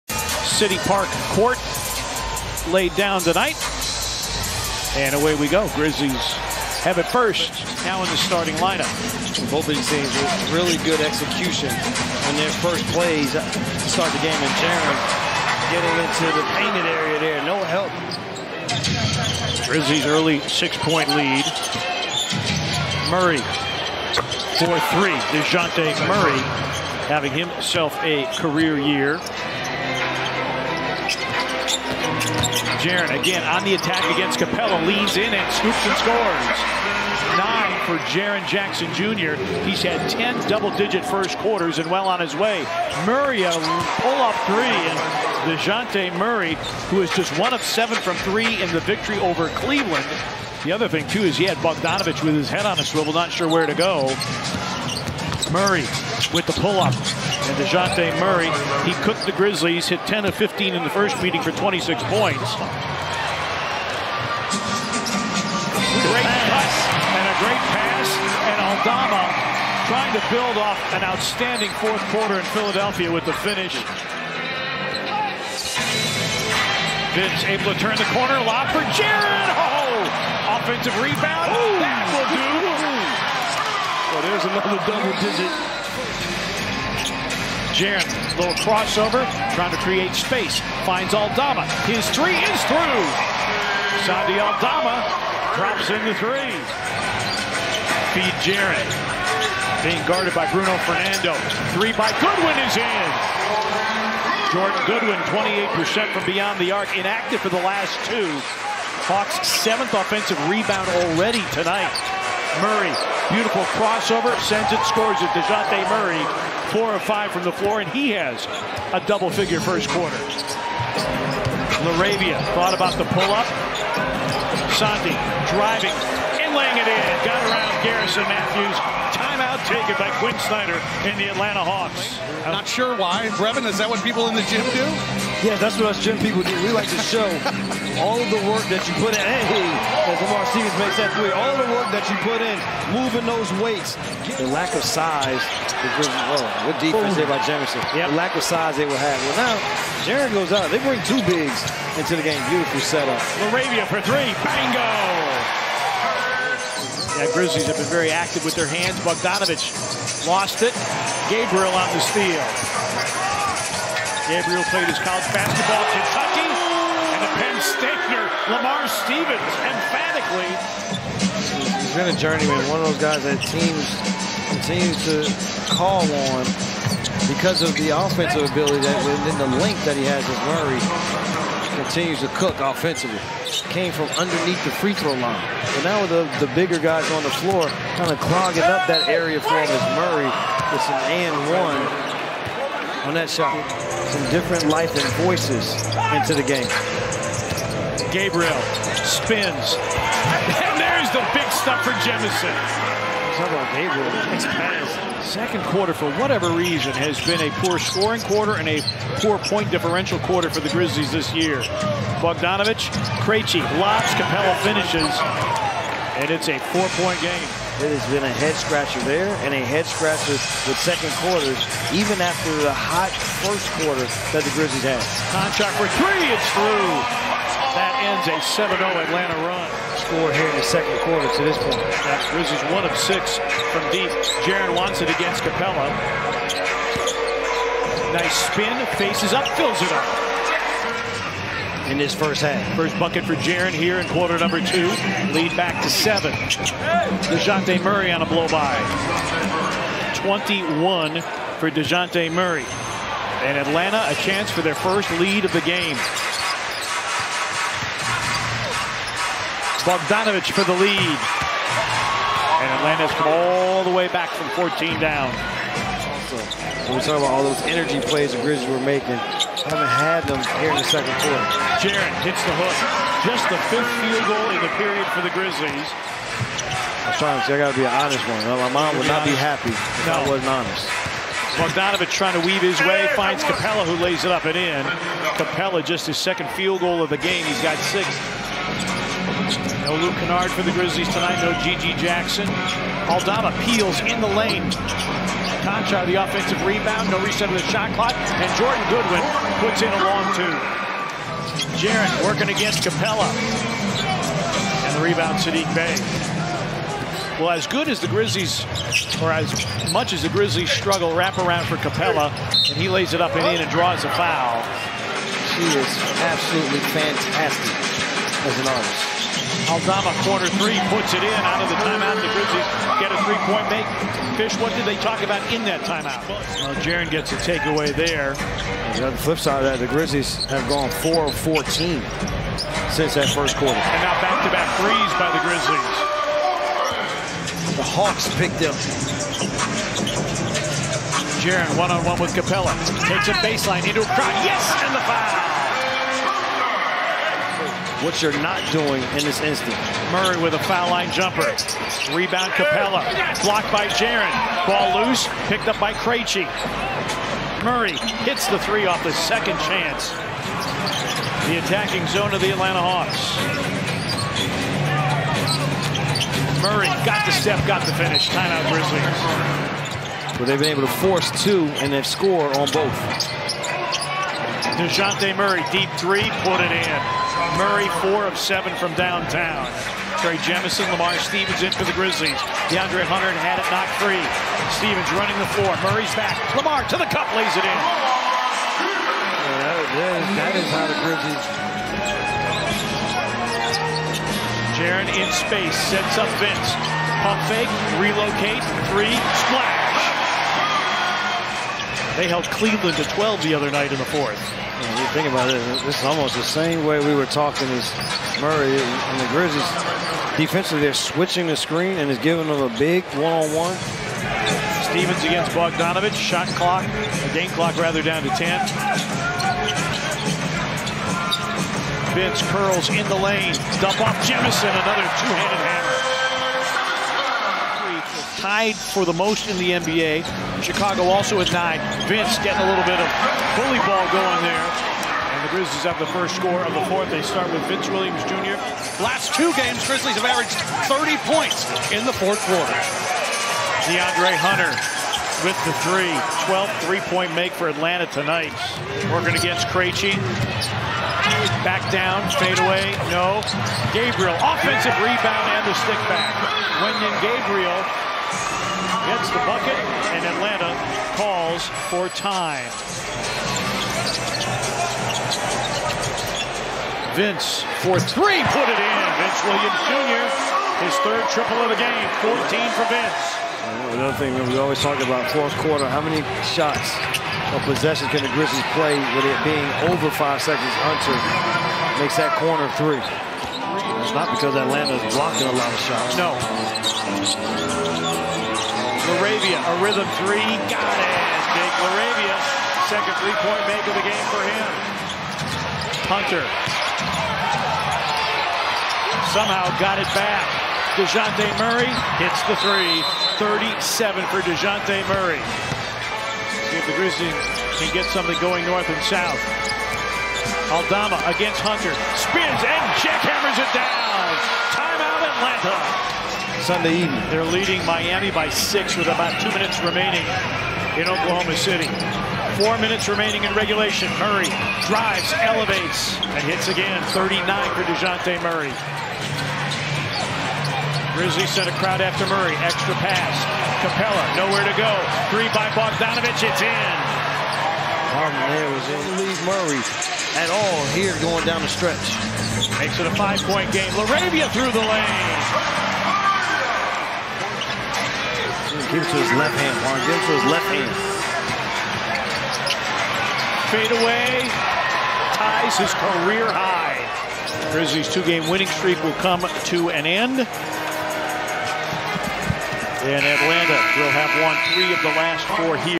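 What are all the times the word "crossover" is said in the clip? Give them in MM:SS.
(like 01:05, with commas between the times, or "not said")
01:28, 01:53.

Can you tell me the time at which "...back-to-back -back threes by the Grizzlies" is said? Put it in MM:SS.
05:34.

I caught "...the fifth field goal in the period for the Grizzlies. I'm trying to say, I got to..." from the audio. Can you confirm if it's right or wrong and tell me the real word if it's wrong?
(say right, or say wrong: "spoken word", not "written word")
right.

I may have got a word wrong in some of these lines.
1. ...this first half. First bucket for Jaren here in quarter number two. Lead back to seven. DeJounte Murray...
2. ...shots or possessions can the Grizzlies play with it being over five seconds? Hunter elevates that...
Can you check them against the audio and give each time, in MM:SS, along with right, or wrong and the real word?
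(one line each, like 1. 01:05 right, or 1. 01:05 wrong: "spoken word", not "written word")
1. 04:01 right
2. 07:56 wrong: "makes", not "elevates".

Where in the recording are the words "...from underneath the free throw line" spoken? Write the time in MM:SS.
03:03.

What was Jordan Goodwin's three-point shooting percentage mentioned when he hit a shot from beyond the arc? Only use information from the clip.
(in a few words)
28%.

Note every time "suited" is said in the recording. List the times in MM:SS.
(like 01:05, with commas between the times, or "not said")
not said.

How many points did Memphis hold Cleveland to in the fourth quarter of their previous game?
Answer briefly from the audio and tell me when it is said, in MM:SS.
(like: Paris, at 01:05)
12, at 06:43.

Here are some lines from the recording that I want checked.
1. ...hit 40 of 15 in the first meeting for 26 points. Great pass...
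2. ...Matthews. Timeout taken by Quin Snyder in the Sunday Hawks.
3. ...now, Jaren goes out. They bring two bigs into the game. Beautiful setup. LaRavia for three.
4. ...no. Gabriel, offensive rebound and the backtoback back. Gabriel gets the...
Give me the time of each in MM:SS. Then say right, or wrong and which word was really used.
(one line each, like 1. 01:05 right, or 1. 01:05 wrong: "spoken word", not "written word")
1. 00:59 wrong: "10", not "40"
2. 02:08 wrong: "Atlanta", not "Sunday"
3. 02:29 right
4. 07:33 wrong: "stick", not "backtoback".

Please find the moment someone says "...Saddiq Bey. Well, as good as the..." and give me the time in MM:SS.
05:05.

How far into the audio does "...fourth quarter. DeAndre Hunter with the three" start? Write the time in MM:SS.
07:22.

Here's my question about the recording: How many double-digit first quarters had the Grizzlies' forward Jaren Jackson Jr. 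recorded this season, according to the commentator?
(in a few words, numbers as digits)
10.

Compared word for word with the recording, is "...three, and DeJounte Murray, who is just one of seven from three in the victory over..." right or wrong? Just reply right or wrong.
right.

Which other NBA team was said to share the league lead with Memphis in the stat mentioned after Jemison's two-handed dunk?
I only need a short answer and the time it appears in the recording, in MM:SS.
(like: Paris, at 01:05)
Chicago, at 07:10.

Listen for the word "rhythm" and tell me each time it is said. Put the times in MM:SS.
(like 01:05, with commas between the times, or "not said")
08:09.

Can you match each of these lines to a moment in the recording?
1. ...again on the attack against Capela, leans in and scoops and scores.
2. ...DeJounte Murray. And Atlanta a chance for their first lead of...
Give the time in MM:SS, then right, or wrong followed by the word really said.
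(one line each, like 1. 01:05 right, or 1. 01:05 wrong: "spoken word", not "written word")
1. 00:33 right
2. 04:11 right.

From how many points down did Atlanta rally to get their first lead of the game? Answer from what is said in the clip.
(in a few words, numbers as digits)
14.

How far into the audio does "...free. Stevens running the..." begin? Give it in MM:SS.
06:23.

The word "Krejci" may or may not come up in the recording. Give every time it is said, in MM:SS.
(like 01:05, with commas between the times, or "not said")
03:33, 05:55, 07:29.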